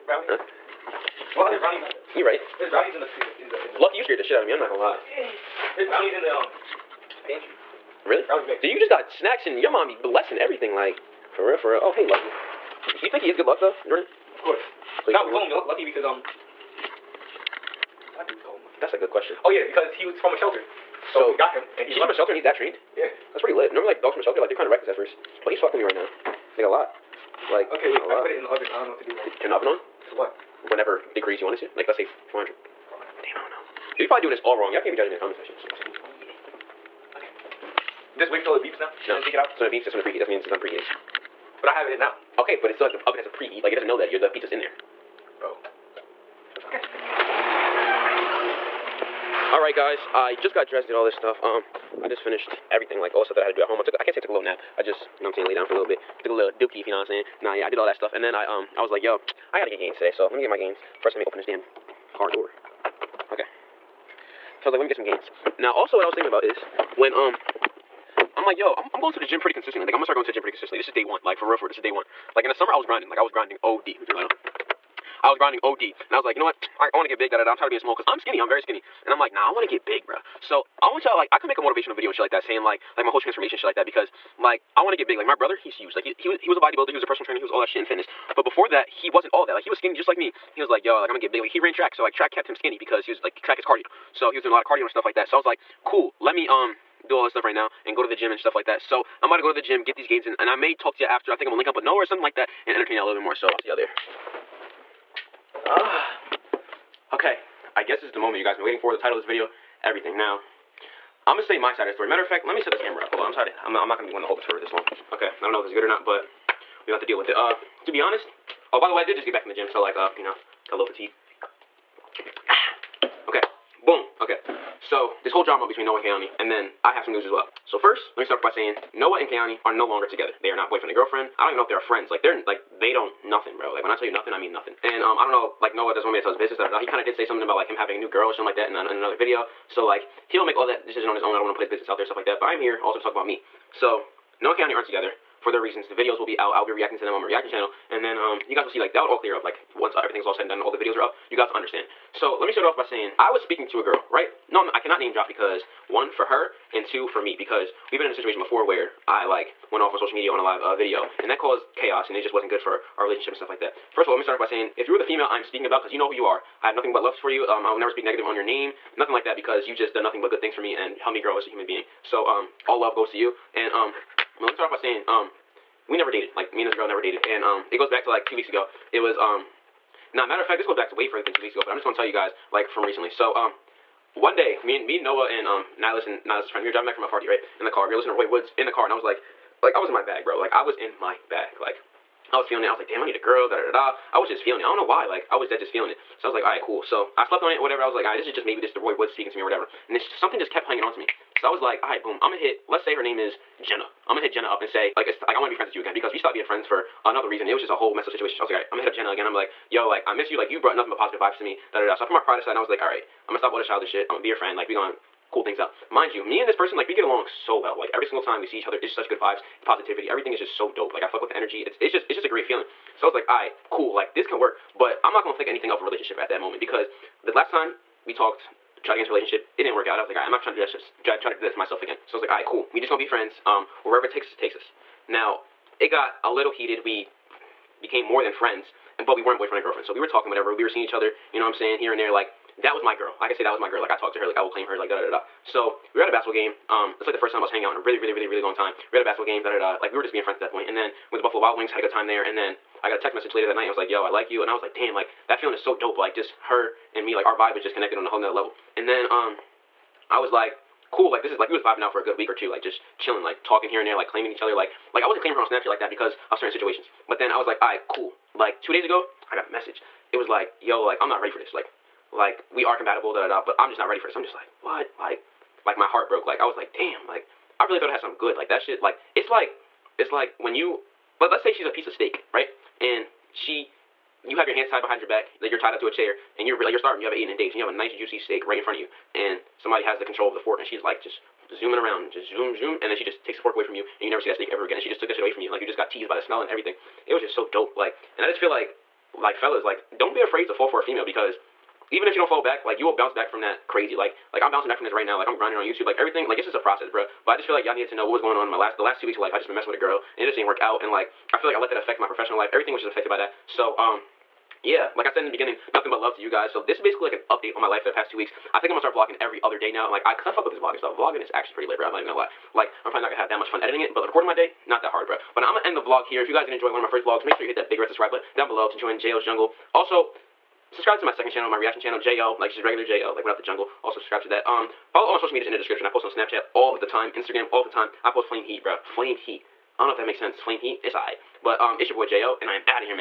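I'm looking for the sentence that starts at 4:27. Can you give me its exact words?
But then I was like, alright, cool.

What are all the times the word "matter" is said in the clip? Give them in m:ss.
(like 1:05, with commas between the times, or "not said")
1:52, 3:00.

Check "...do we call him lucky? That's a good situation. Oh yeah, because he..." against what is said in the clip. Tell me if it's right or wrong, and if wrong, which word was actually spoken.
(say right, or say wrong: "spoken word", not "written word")
wrong: "question", not "situation".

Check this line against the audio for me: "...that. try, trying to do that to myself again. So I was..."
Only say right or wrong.
right.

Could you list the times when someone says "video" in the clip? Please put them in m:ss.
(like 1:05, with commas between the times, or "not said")
1:21, 1:49, 2:19, 2:25, 2:30, 2:40.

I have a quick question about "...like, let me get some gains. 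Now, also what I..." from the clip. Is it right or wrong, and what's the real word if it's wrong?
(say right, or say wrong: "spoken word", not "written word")
right.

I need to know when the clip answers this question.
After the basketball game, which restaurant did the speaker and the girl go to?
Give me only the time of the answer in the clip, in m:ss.
4:11.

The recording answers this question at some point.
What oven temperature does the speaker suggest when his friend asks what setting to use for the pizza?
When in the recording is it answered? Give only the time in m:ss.
0:32.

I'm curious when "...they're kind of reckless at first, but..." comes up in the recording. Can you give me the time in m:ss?
0:24.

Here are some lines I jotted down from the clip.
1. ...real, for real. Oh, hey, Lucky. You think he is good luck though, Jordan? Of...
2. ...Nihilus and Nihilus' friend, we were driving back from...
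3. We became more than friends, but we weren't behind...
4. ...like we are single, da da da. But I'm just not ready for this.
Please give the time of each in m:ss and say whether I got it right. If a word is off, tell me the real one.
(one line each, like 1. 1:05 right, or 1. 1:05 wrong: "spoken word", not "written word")
1. 0:11 right
2. 3:05 right
3. 3:56 wrong: "boyfriend", not "behind"
4. 4:32 wrong: "compatible", not "single".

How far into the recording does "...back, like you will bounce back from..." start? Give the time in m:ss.
5:02.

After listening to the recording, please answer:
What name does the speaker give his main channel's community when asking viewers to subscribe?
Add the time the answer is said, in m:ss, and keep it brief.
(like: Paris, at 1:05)
JL's Jungle, at 5:28.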